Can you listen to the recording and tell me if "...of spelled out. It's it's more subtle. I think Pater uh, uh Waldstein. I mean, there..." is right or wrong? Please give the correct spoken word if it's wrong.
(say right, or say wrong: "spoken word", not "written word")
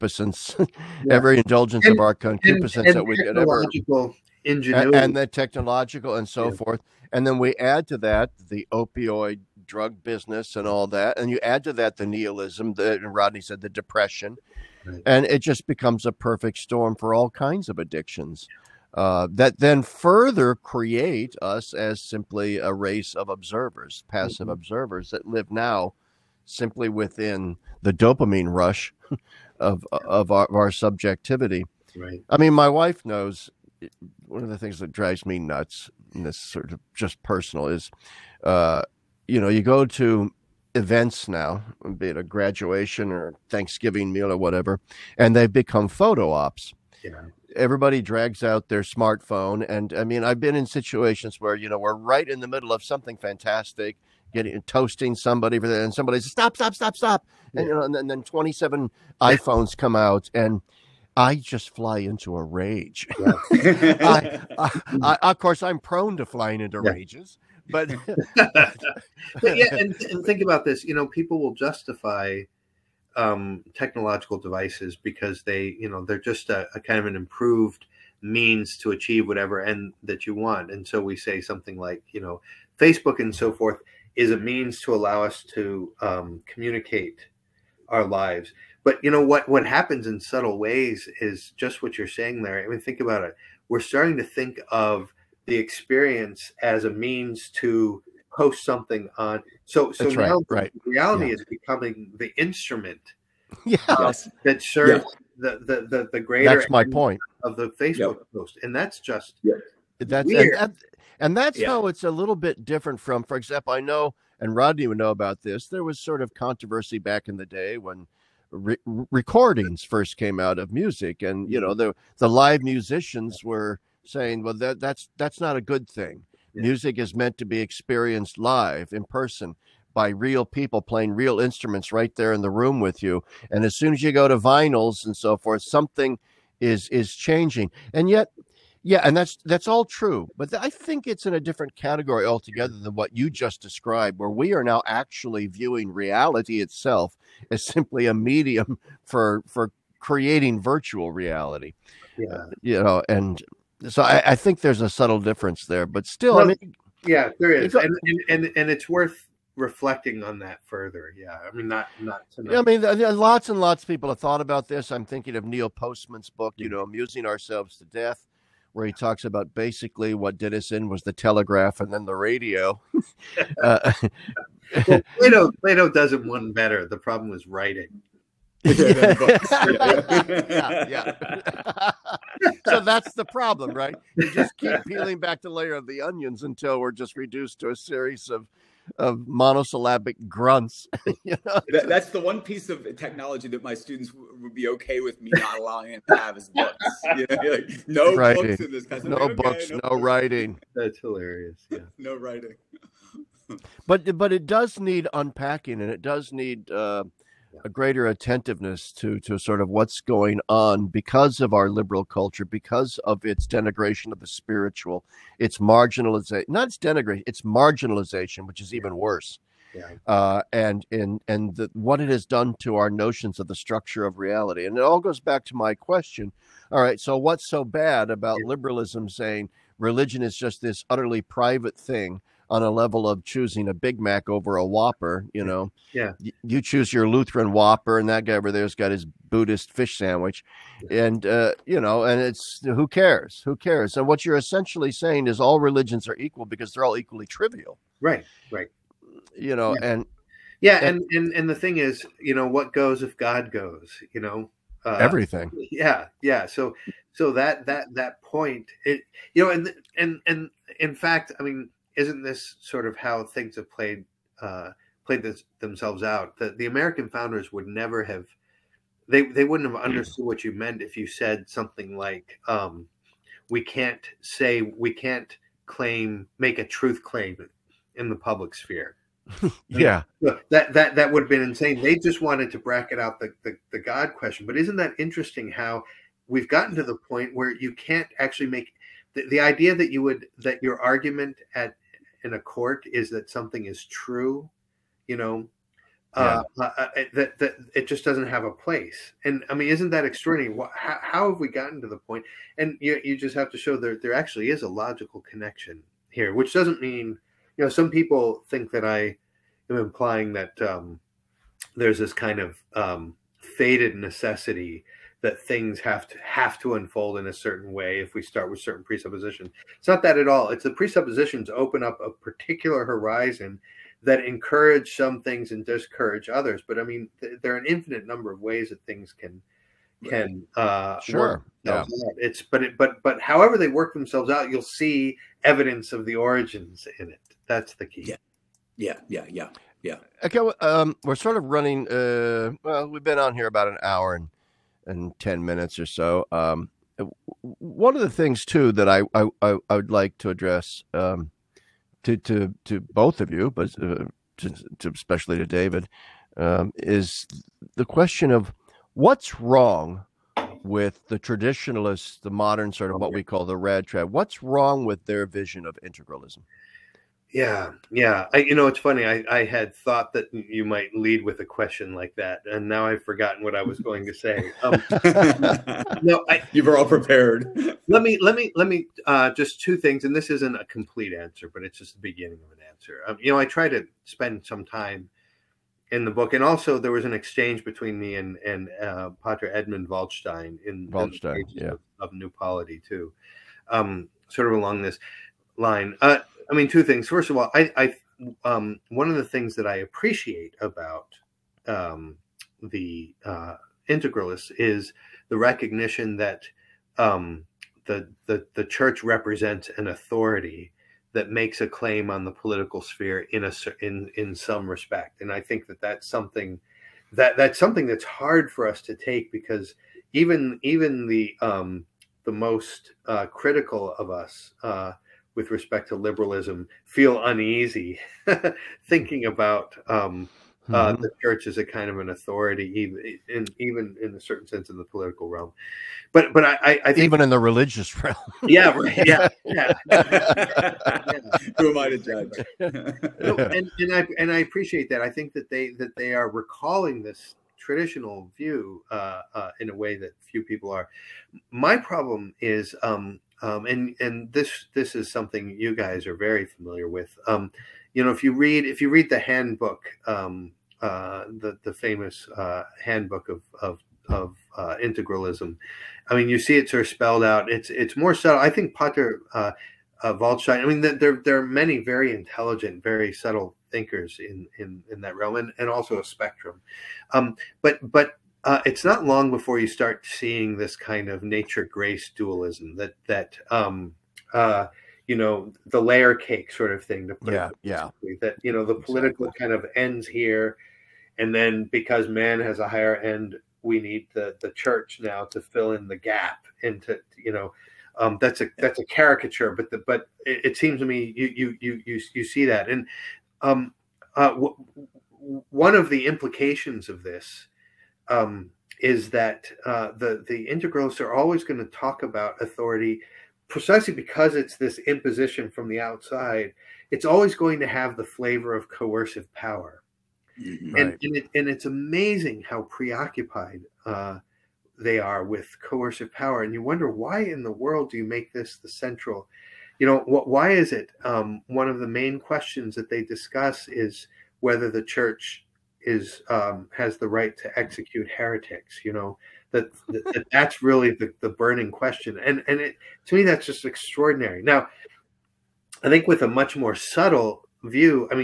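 right.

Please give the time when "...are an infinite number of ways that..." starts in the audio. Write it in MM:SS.
05:27.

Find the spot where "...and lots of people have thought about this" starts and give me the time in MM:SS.
02:43.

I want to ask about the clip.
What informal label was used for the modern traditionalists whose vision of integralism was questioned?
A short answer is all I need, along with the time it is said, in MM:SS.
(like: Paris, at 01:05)
rad trad, at 06:03.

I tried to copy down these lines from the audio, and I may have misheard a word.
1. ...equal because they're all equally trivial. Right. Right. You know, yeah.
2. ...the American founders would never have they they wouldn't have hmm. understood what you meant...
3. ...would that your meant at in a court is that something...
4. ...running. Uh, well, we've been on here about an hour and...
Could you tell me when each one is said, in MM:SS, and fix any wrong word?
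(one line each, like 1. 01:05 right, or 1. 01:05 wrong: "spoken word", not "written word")
1. 04:06 right
2. 04:26 right
3. 04:50 wrong: "argument", not "meant"
4. 05:41 right.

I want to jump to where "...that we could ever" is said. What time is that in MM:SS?
00:02.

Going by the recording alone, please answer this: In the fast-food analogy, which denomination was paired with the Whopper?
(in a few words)
Lutheran.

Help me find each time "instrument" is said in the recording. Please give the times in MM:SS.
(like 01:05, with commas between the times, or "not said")
01:42, 02:11.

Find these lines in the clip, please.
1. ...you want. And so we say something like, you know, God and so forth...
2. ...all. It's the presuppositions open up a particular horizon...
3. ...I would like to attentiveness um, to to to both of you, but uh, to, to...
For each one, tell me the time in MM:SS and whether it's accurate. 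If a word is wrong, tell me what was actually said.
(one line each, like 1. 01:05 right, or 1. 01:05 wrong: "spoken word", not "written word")
1. 01:20 wrong: "Facebook", not "God"
2. 05:20 right
3. 05:49 wrong: "address", not "attentiveness".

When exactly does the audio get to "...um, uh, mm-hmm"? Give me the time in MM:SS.
07:09.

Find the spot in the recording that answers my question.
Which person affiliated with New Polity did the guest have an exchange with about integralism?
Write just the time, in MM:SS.
06:29.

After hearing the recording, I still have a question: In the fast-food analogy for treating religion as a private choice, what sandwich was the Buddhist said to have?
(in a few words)
fish sandwich.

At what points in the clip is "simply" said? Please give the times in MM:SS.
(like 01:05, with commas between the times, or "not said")
00:22, 00:26, 02:27.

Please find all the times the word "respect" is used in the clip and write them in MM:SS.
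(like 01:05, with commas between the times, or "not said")
06:54, 07:05.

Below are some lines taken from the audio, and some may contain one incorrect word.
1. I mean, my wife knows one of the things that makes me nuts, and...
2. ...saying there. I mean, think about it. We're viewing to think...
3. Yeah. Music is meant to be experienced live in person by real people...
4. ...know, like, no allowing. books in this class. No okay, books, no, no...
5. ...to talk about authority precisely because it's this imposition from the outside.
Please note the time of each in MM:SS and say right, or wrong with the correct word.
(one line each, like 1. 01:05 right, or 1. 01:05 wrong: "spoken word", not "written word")
1. 00:32 wrong: "drives", not "makes"
2. 01:32 wrong: "starting", not "viewing"
3. 02:06 right
4. 03:17 wrong: "writing", not "allowing"
5. 08:31 right.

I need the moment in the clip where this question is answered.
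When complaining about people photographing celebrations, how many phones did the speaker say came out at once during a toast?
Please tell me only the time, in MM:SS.
00:58.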